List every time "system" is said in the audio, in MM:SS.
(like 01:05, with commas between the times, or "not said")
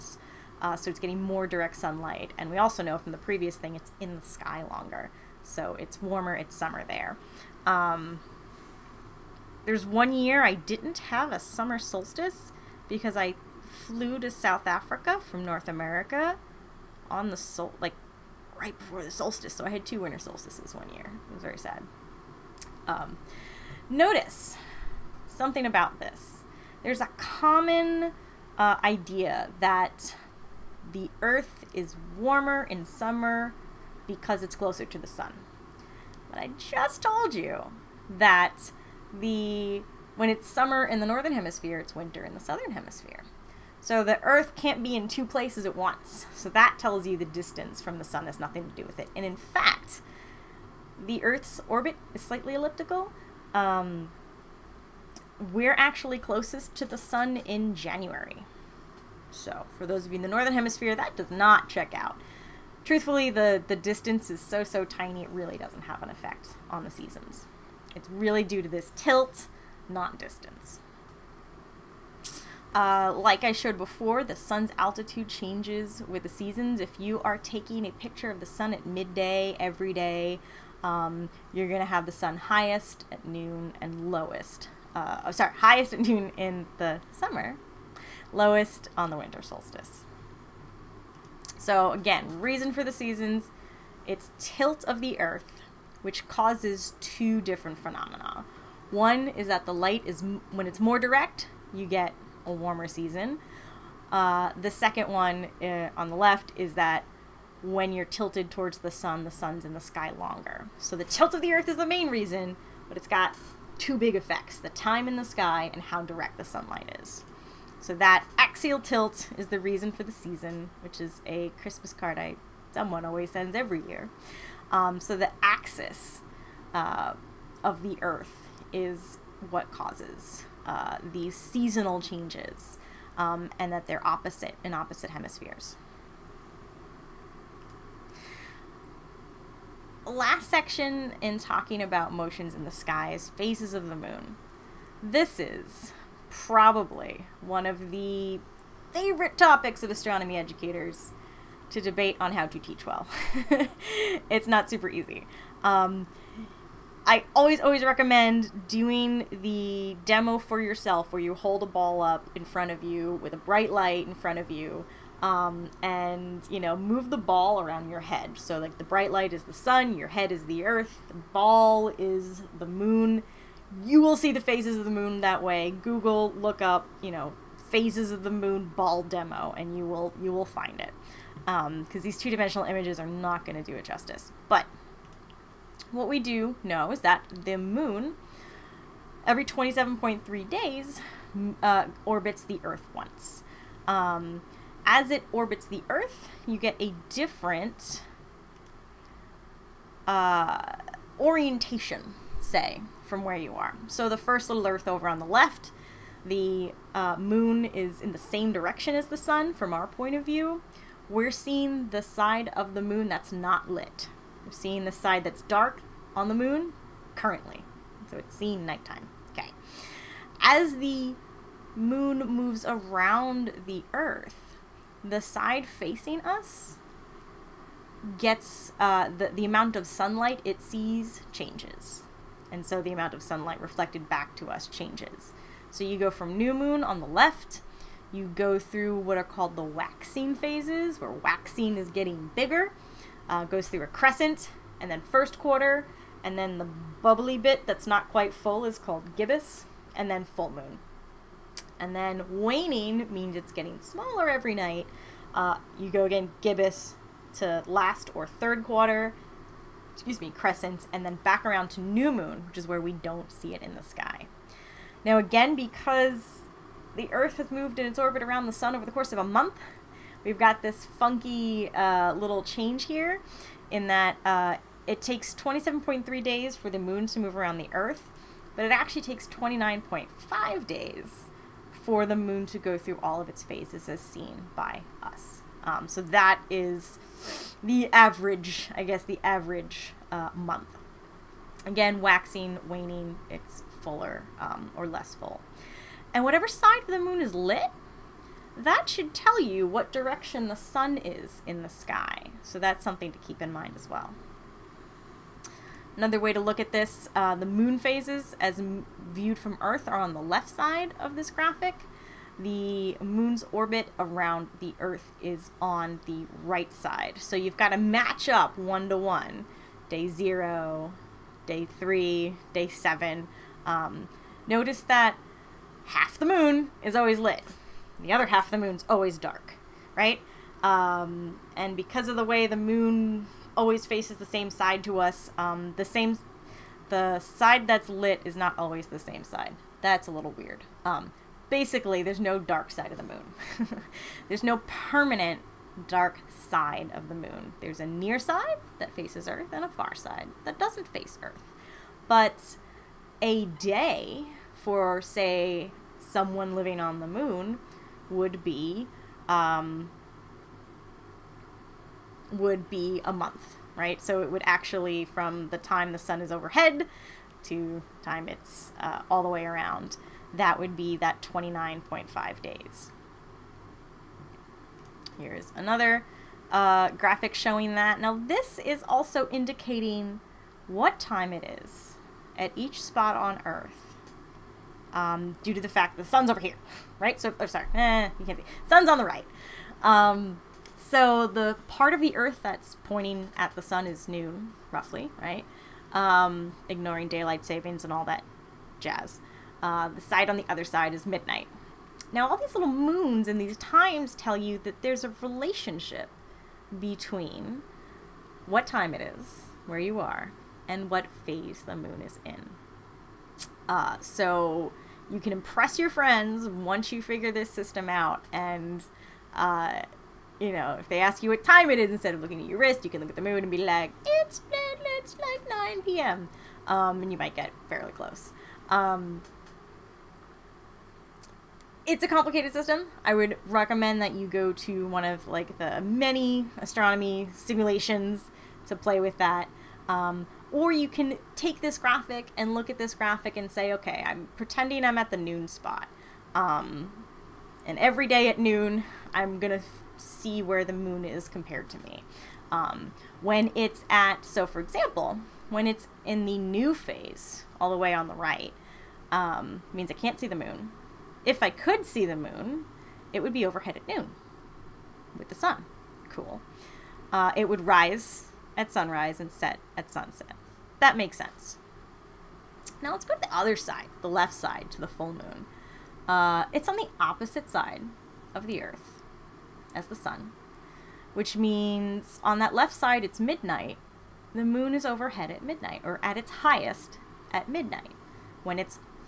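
06:57, 07:12.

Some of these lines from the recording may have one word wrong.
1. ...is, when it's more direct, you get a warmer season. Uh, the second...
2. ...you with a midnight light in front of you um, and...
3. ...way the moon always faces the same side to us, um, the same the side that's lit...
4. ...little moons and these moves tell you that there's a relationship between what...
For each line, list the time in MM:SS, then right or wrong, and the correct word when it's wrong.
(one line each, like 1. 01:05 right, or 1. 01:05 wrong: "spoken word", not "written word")
1. 01:40 right
2. 02:42 wrong: "bright", not "midnight"
3. 05:32 right
4. 06:42 wrong: "times", not "moves".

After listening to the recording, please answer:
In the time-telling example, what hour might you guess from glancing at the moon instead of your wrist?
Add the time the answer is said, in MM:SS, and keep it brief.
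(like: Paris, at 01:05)
9 p.m., at 07:05.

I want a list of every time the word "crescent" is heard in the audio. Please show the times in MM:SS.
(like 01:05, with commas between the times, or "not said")
04:03, 04:20.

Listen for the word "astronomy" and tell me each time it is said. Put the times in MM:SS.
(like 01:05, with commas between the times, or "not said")
02:29, 07:16.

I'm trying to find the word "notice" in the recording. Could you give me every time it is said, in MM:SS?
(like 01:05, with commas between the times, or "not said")
00:23, 05:24.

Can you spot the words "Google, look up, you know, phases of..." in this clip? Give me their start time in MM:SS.
02:55.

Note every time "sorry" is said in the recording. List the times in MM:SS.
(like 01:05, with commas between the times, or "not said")
01:25, 06:27.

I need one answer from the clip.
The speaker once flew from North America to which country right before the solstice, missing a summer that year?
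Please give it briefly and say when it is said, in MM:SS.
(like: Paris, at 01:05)
South Africa, at 00:14.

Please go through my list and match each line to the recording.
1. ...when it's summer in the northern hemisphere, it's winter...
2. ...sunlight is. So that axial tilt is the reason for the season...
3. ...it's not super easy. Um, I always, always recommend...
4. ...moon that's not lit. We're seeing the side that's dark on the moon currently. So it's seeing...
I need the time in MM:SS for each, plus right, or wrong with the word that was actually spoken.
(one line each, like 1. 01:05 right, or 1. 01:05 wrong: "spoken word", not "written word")
1. 00:40 right
2. 01:56 right
3. 02:34 right
4. 03:32 right.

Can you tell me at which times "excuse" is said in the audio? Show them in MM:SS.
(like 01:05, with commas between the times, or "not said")
04:19.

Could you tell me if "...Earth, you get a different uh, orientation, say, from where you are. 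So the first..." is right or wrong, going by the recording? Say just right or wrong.
right.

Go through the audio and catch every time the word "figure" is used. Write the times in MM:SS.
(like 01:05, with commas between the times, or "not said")
06:57.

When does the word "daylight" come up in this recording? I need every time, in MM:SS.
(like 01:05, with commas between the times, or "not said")
06:37.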